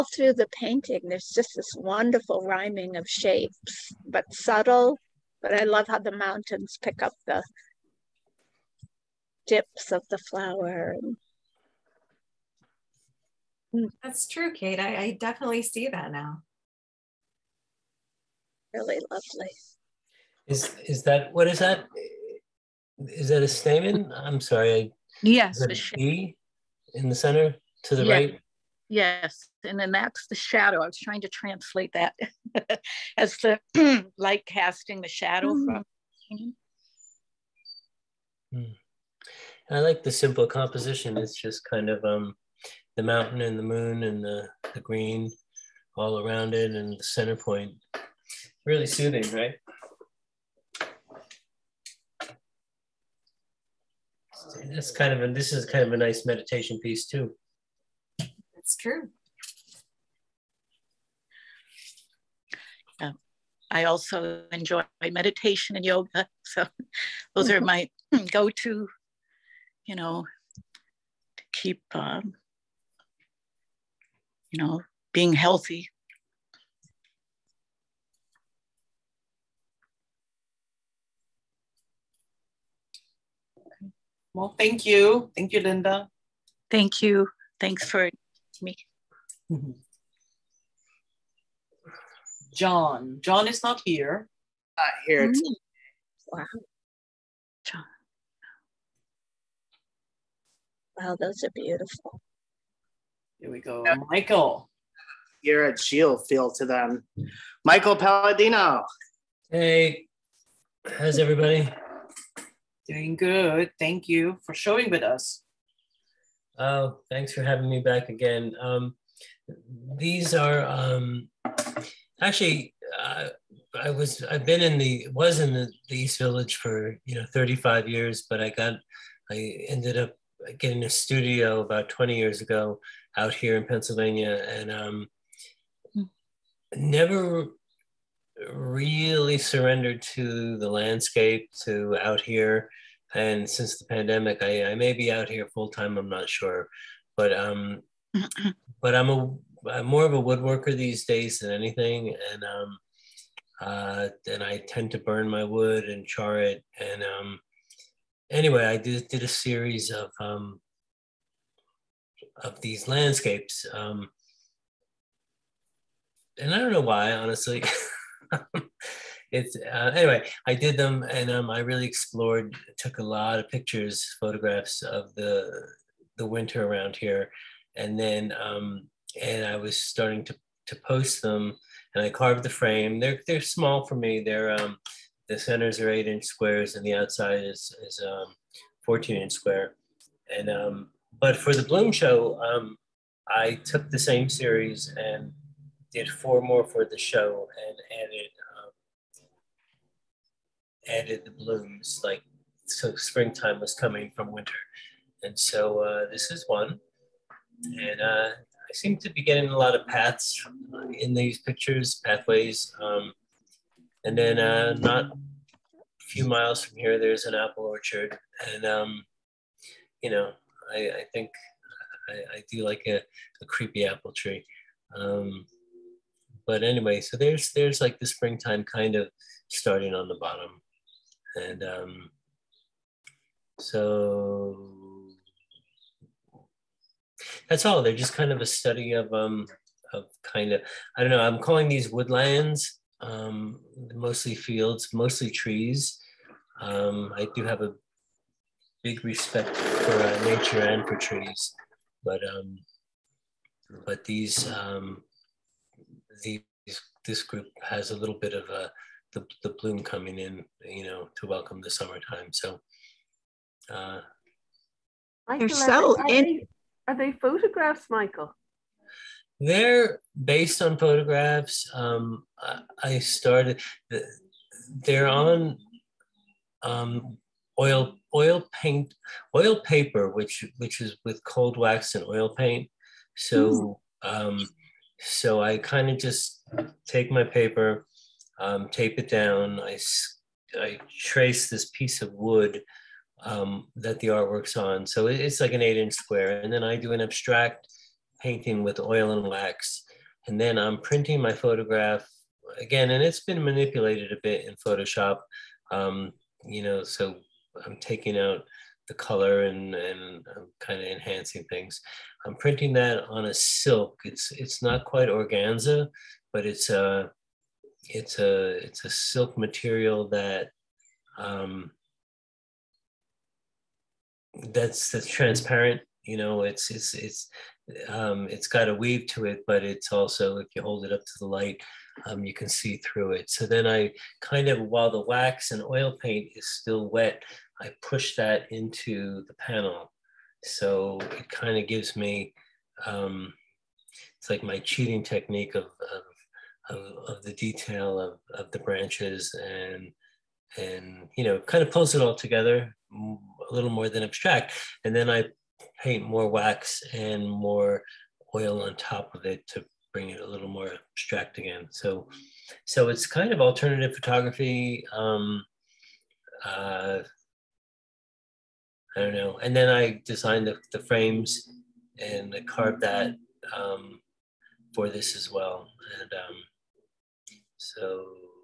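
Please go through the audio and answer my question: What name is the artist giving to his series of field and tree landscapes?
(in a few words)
woodlands.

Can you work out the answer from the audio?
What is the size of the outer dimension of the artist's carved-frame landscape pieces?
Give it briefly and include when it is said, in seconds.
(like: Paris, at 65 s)
14 inch square, at 188 s.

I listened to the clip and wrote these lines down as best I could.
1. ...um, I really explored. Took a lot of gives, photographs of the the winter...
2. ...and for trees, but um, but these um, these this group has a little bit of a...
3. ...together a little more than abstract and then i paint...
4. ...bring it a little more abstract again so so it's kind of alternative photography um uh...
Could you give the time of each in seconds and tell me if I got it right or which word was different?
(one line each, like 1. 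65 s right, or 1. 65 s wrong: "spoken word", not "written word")
1. 171 s wrong: "pictures", not "gives"
2. 250 s right
3. 352 s right
4. 359 s right.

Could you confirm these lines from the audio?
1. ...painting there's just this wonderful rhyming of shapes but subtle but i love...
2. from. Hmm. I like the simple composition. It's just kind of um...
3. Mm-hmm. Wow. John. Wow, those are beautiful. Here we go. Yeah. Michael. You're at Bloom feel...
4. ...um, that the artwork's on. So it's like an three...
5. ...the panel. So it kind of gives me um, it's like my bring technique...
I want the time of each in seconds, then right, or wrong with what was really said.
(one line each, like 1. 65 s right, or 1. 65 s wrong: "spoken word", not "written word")
1. 0 s right
2. 35 s right
3. 95 s wrong: "Shield", not "Bloom"
4. 293 s wrong: "eight", not "three"
5. 339 s wrong: "cheating", not "bring".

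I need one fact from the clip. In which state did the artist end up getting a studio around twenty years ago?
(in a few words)
Pennsylvania.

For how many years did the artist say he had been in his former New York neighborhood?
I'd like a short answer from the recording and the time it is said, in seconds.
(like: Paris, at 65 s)
35, at 127 s.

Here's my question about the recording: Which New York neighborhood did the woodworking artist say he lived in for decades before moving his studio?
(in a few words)
East Village.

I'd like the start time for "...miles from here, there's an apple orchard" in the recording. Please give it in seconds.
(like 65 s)
216 s.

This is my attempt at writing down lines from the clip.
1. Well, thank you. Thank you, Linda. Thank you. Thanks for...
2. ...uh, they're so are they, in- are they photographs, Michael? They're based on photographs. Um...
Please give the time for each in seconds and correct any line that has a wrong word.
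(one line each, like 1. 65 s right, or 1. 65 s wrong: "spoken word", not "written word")
1. 84 s right
2. 263 s right.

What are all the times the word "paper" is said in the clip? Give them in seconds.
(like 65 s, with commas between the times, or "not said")
279 s, 287 s.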